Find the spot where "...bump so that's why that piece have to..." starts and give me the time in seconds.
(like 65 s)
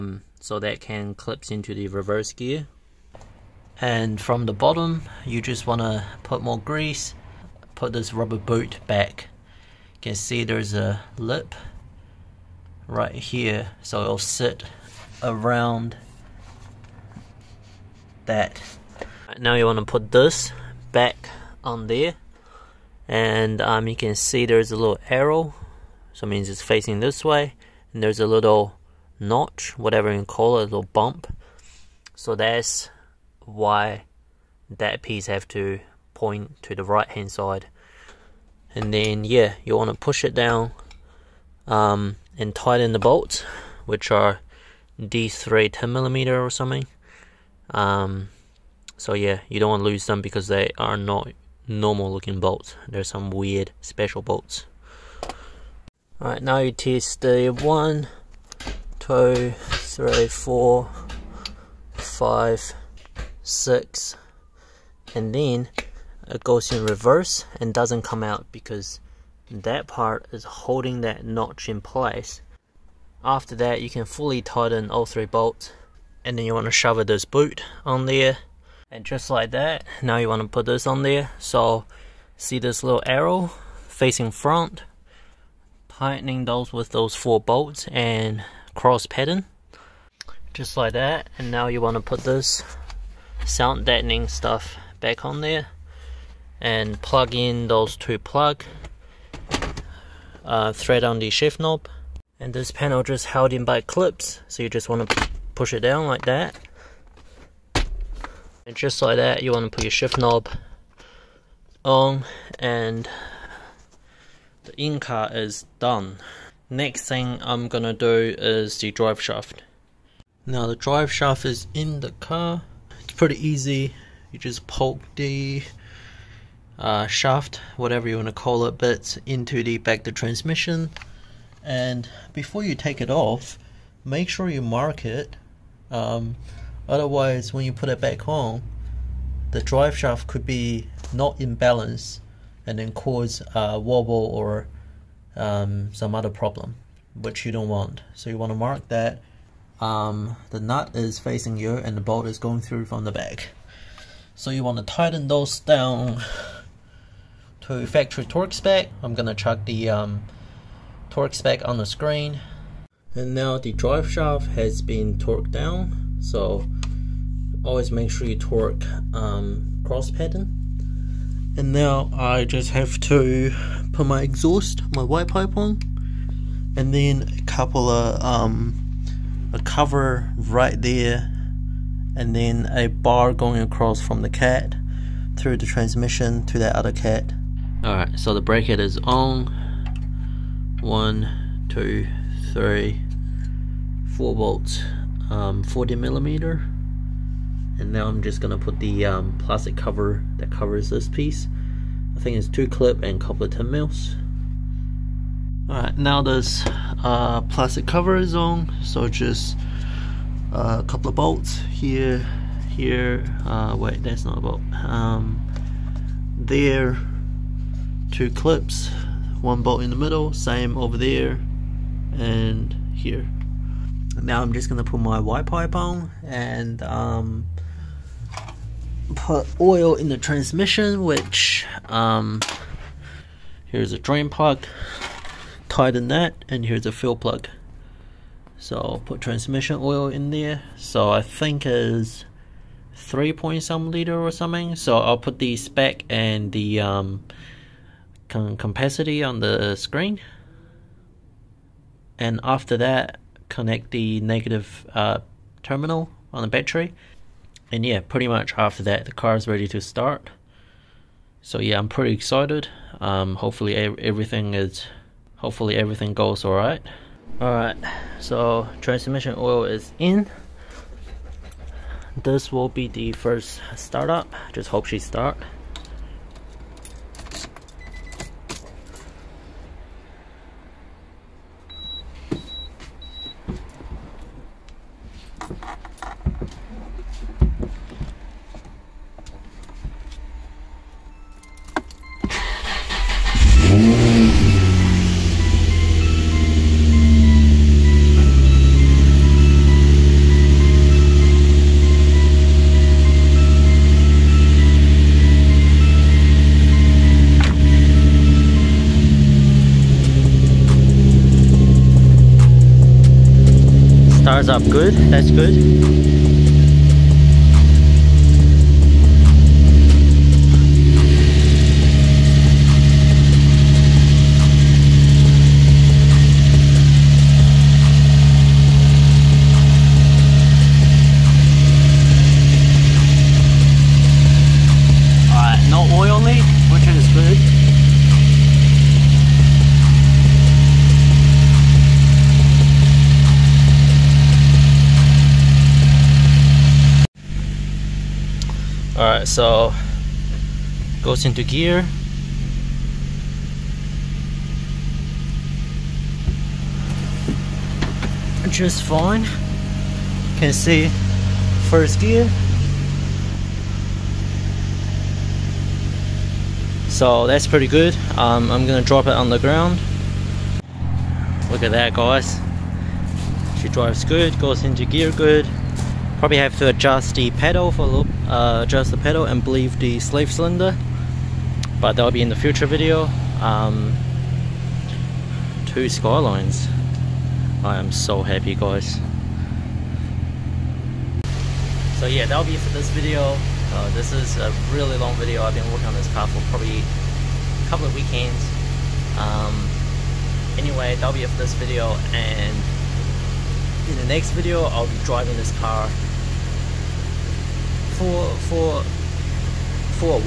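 30 s.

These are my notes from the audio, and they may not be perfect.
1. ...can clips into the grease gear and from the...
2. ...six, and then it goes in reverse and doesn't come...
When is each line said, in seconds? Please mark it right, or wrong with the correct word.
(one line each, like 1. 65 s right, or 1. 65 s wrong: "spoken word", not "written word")
1. 0 s wrong: "reverse", not "grease"
2. 63 s right.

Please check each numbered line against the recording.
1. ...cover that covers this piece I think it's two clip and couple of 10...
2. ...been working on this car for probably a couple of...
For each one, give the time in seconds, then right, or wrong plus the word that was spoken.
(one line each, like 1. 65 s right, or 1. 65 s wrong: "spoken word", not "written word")
1. 199 s right
2. 395 s right.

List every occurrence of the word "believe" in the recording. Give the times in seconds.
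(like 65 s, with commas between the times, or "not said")
379 s.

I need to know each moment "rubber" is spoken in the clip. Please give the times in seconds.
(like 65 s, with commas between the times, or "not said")
8 s.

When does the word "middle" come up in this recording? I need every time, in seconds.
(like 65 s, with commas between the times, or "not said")
219 s.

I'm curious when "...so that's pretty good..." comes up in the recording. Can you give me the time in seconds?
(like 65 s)
366 s.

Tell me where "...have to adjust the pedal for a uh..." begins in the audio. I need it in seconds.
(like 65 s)
376 s.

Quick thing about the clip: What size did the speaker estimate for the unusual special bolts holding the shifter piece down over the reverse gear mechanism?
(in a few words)
10 millimeter.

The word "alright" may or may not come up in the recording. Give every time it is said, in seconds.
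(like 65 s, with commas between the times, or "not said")
56 s, 187 s, 205 s.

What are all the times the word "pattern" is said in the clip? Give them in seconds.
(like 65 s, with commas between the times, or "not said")
89 s, 170 s.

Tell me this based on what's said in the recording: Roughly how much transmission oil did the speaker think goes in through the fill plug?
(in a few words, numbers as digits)
3 point some liters.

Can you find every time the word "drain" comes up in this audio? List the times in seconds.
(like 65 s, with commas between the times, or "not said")
233 s.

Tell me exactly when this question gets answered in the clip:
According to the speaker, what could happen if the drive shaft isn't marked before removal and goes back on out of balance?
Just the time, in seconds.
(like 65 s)
143 s.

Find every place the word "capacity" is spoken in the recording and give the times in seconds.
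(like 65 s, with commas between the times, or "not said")
248 s.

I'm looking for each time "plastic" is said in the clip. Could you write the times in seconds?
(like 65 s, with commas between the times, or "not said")
199 s, 207 s.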